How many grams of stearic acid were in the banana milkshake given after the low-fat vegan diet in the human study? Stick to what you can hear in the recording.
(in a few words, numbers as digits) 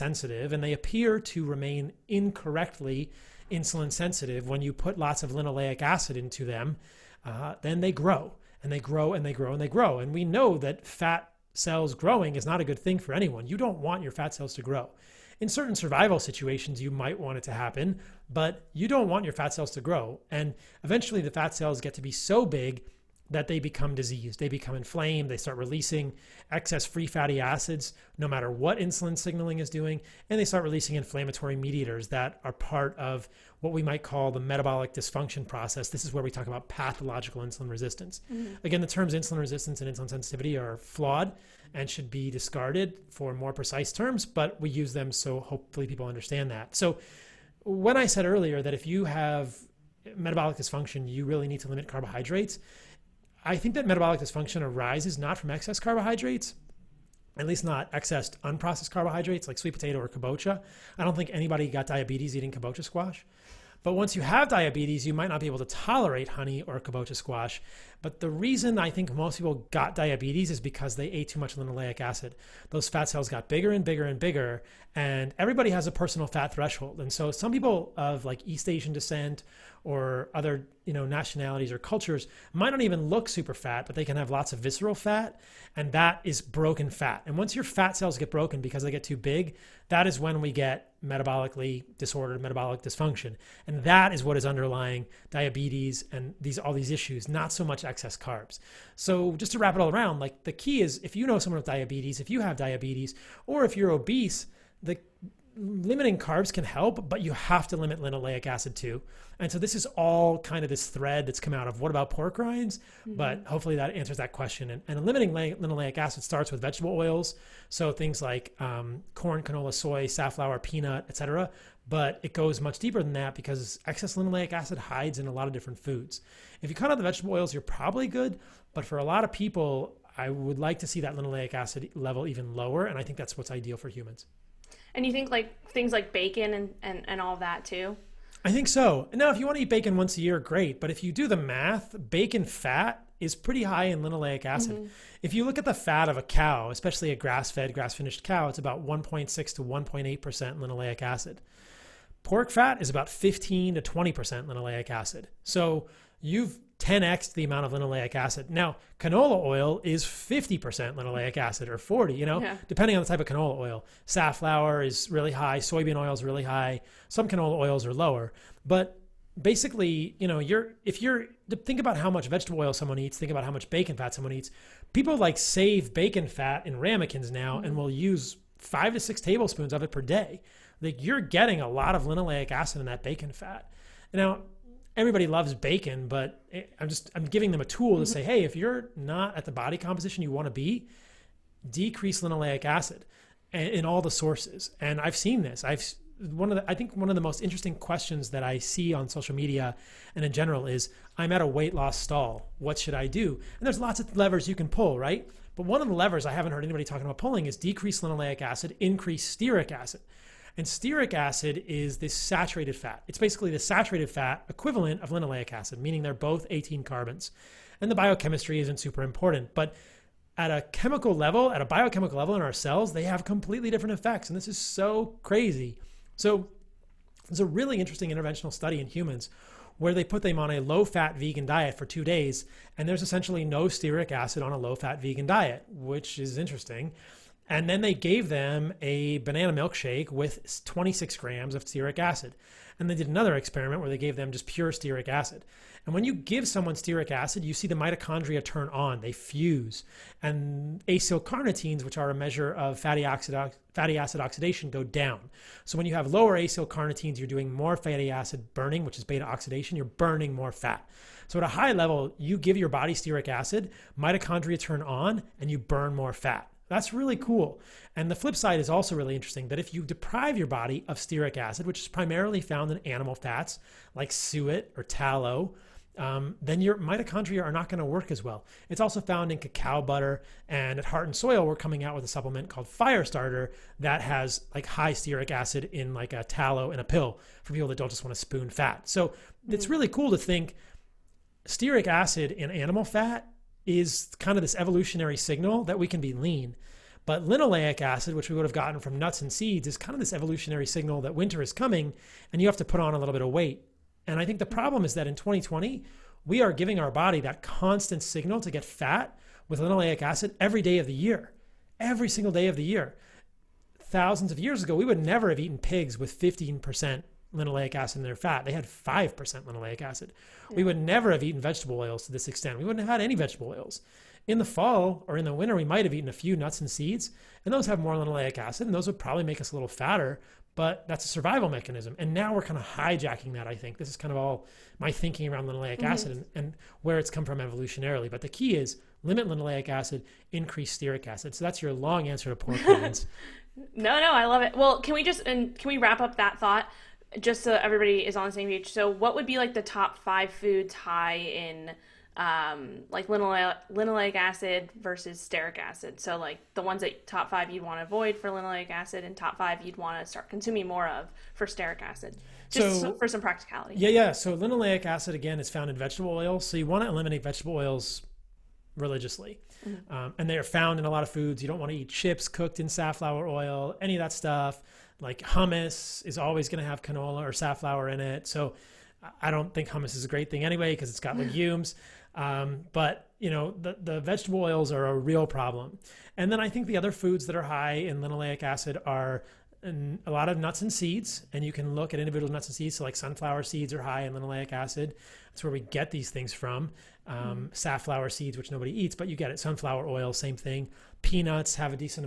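26 grams.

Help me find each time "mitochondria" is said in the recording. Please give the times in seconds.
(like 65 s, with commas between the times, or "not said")
247 s, 263 s, 276 s.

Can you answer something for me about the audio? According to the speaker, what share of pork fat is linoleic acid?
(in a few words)
15 to 20%.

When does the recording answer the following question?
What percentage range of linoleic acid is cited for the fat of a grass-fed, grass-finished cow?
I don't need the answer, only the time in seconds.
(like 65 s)
148 s.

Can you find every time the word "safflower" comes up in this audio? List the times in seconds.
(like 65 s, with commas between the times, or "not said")
120 s, 164 s, 372 s, 377 s, 397 s.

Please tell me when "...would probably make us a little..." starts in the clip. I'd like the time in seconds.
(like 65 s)
328 s.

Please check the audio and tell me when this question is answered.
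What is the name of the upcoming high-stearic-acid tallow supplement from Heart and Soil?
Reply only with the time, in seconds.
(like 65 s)
282 s.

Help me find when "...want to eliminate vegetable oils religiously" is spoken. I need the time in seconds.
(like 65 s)
366 s.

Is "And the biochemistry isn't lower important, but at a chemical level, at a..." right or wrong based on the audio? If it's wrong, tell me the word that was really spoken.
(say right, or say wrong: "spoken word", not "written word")
wrong: "super", not "lower".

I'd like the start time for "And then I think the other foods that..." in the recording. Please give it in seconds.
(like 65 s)
386 s.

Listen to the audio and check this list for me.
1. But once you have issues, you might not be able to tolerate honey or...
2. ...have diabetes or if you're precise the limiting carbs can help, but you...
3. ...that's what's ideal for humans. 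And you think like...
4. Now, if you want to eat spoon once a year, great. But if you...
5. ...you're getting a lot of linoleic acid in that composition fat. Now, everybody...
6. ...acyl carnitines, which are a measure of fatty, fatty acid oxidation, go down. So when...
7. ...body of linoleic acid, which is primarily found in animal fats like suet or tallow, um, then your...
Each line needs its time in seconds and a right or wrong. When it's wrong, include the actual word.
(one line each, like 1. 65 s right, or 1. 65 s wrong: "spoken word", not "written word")
1. 63 s wrong: "diabetes", not "issues"
2. 102 s wrong: "obese", not "precise"
3. 133 s right
4. 139 s wrong: "bacon", not "spoon"
5. 181 s wrong: "bacon", not "composition"
6. 250 s right
7. 270 s wrong: "stearic", not "linoleic".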